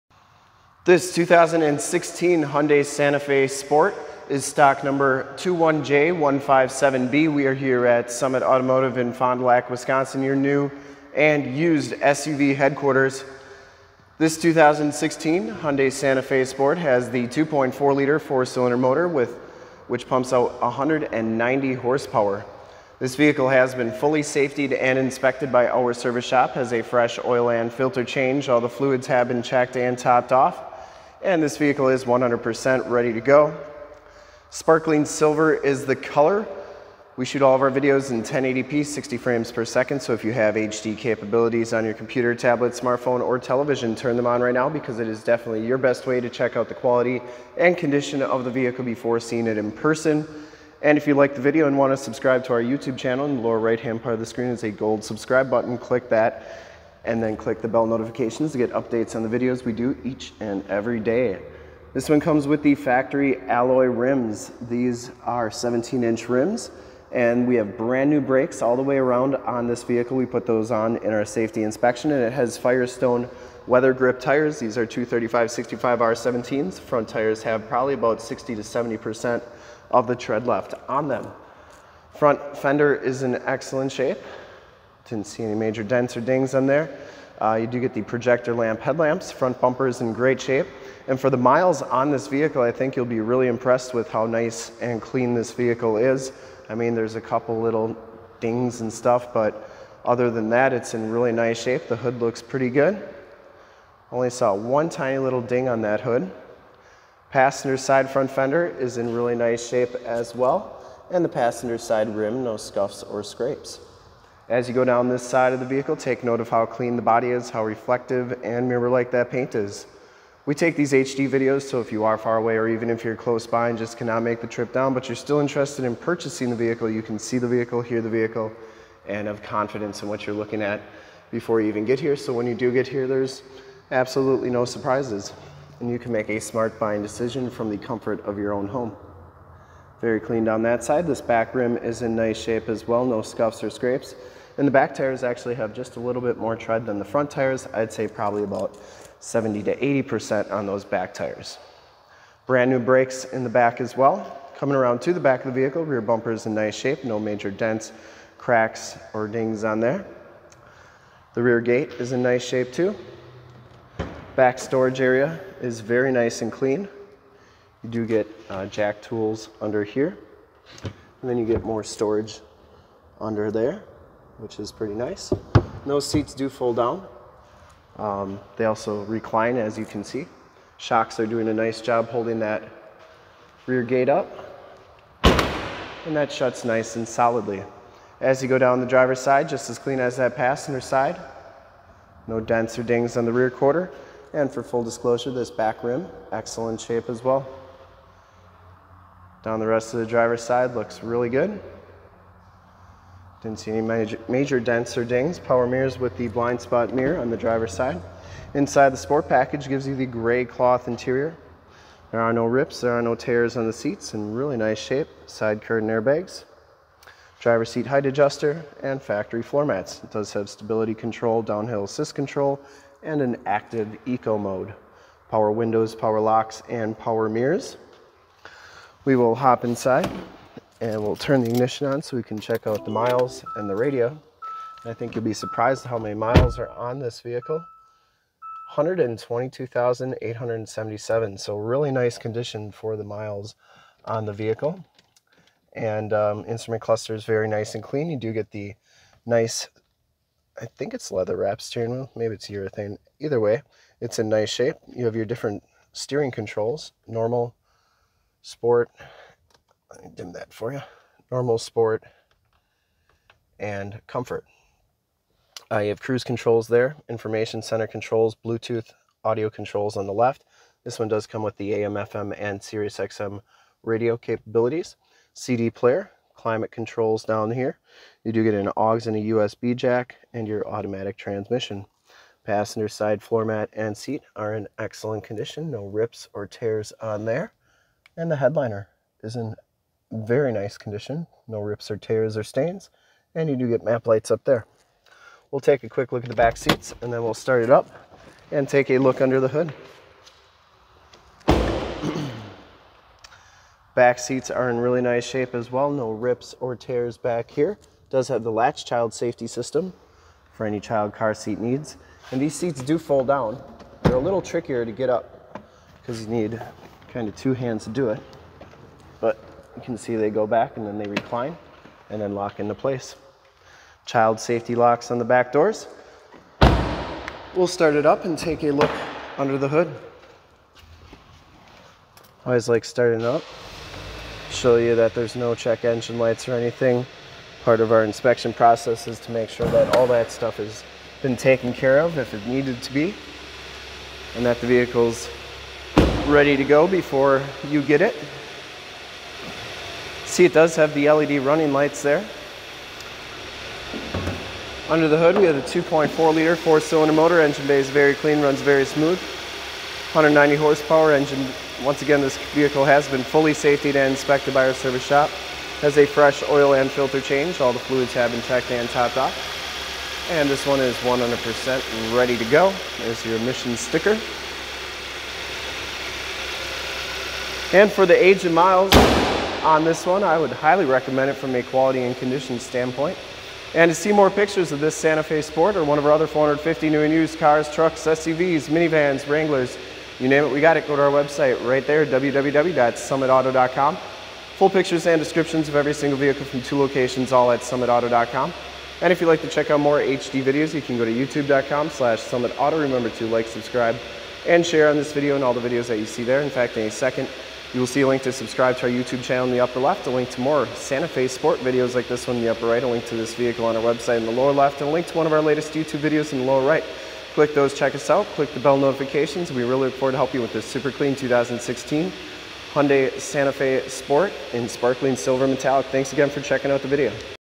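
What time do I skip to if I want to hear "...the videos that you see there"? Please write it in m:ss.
6:45.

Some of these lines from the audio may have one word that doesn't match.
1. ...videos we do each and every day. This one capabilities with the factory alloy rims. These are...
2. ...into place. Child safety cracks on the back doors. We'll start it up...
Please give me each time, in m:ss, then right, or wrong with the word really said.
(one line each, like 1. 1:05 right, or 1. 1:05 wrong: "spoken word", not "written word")
1. 0:59 wrong: "comes", not "capabilities"
2. 5:22 wrong: "locks", not "cracks".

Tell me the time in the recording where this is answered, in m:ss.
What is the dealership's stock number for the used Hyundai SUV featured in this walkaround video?
0:05.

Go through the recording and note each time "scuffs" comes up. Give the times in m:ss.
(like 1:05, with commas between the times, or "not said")
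1:52, 2:23.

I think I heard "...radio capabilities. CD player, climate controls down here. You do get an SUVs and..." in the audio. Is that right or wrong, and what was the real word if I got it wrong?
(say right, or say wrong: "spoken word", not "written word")
wrong: "AUX", not "SUVs".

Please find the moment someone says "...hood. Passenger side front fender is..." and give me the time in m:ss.
1:46.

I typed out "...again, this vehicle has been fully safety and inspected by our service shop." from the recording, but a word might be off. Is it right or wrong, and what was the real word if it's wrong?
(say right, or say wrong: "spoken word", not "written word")
right.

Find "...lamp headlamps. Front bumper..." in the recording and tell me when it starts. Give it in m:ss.
1:28.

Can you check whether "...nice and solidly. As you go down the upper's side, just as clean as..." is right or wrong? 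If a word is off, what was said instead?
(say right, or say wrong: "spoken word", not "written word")
wrong: "driver", not "upper".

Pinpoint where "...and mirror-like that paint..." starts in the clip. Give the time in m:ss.
1:58.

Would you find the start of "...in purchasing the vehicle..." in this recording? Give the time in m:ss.
2:05.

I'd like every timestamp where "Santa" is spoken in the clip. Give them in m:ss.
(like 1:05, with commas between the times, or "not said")
0:02, 0:15, 6:24, 6:50, 7:03.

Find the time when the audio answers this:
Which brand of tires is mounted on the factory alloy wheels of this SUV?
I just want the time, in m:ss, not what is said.
1:12.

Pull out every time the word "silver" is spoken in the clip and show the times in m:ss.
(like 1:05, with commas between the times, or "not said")
0:35, 7:05.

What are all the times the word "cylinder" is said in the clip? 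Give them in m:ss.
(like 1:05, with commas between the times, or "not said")
0:18, 5:56.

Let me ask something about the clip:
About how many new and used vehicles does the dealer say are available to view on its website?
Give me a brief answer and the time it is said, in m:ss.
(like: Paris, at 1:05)
450, at 6:26.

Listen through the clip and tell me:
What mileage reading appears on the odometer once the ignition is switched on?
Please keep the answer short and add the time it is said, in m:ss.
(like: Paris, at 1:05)
122,877, at 3:58.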